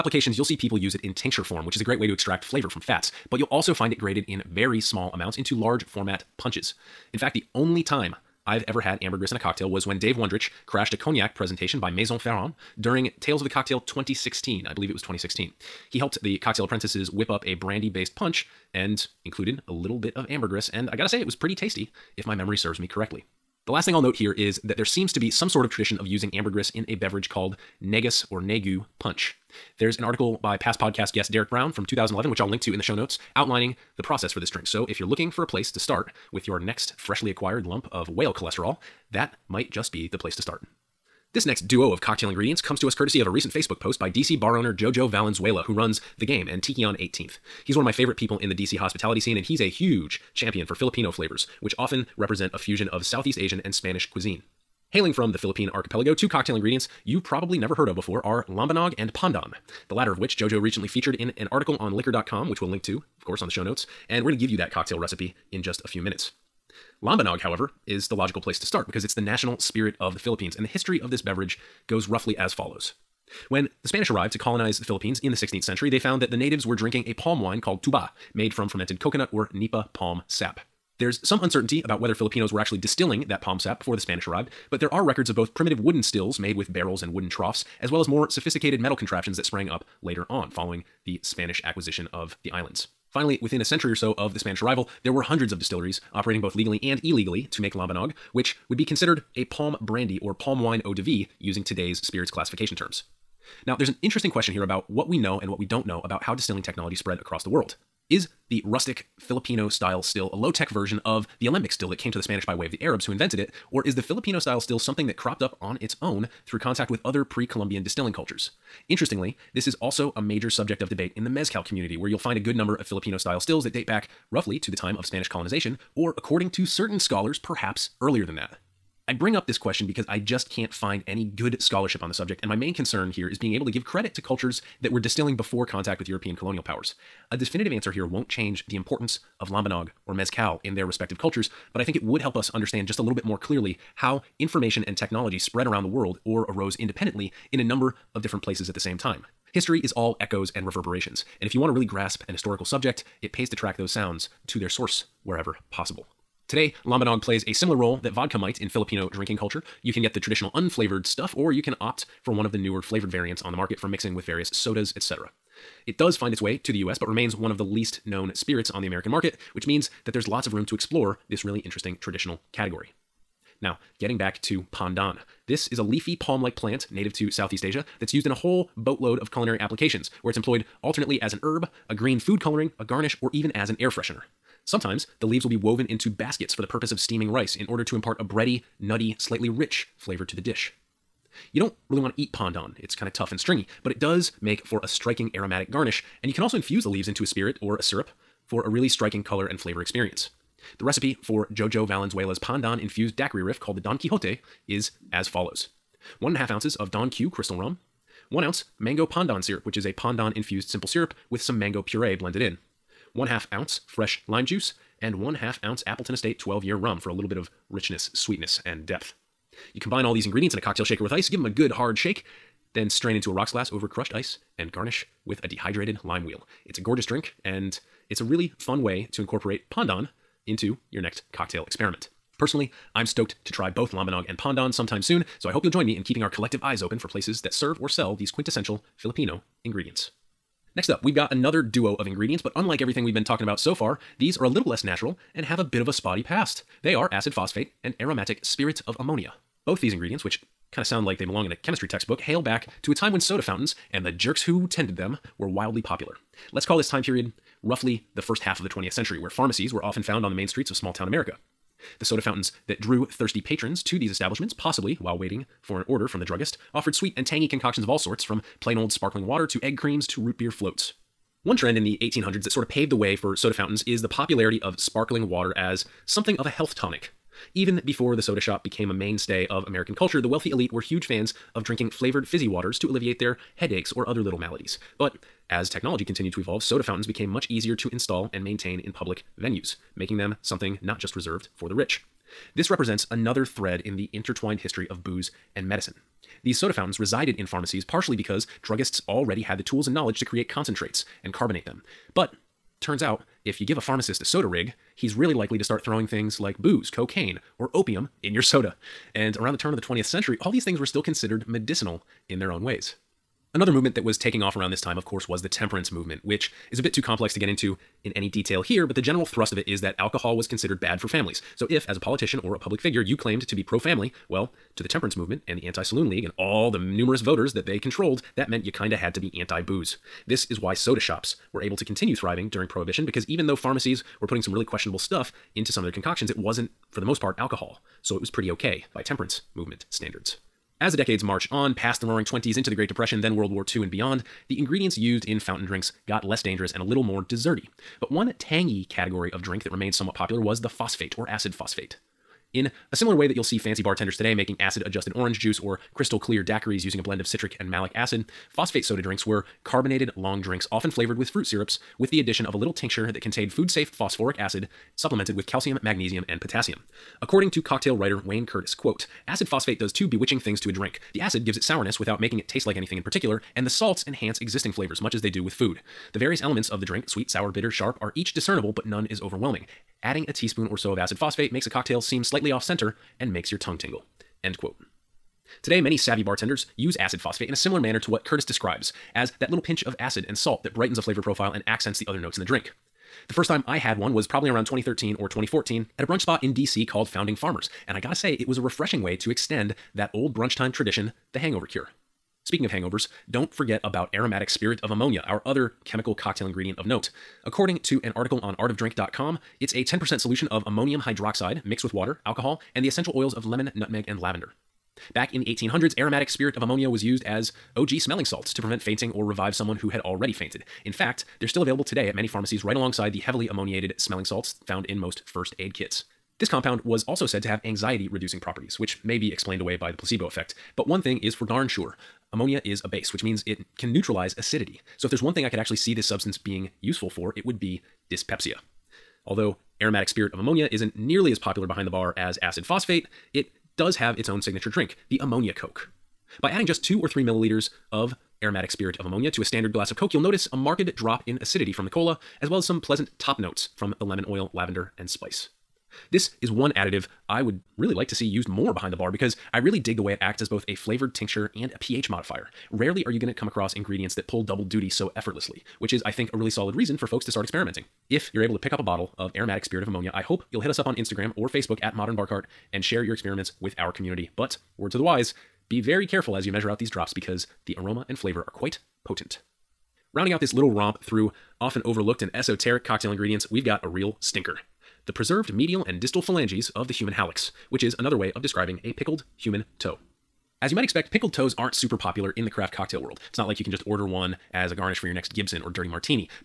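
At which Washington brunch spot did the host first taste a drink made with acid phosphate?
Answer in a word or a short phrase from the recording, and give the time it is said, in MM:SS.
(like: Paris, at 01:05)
Founding Farmers, at 06:37.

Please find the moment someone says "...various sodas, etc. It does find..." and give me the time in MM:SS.
02:44.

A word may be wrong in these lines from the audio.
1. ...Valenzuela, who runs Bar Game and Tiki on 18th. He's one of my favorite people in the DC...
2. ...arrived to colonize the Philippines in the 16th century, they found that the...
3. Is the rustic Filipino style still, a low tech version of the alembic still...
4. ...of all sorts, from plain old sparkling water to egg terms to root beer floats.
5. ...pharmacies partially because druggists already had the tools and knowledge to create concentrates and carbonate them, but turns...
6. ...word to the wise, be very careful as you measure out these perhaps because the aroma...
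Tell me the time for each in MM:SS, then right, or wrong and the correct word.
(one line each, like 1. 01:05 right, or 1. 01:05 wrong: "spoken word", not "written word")
1. 00:45 wrong: "The", not "Bar"
2. 01:14 right
3. 01:48 right
4. 04:27 wrong: "creams", not "terms"
5. 04:57 right
6. 07:54 wrong: "drops", not "perhaps".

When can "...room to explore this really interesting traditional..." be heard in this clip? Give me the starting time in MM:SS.
02:50.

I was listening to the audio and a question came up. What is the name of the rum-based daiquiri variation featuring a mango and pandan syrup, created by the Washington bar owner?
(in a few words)
Don Quixote.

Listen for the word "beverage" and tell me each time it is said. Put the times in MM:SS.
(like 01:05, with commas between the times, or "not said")
00:26, 01:11.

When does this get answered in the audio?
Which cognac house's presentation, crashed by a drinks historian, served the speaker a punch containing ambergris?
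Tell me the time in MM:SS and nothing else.
00:11.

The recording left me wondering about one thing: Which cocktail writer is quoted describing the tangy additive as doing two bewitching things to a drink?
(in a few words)
Wayne Curtis.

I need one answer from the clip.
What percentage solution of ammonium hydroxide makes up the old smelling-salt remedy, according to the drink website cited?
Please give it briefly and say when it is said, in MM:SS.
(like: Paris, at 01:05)
10%, at 06:49.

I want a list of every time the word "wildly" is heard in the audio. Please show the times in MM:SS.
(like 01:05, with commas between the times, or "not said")
04:15.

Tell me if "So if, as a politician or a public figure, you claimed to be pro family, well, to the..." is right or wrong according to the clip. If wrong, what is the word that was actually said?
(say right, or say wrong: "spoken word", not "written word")
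right.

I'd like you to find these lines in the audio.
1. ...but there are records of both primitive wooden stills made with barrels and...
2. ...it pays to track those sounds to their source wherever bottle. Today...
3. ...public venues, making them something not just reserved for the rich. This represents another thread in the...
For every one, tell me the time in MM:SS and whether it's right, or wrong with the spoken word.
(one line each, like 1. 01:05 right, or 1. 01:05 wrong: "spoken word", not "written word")
1. 01:24 right
2. 02:33 wrong: "possible", not "bottle"
3. 04:48 right.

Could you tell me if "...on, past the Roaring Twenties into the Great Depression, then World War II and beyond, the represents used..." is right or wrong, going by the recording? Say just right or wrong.
wrong.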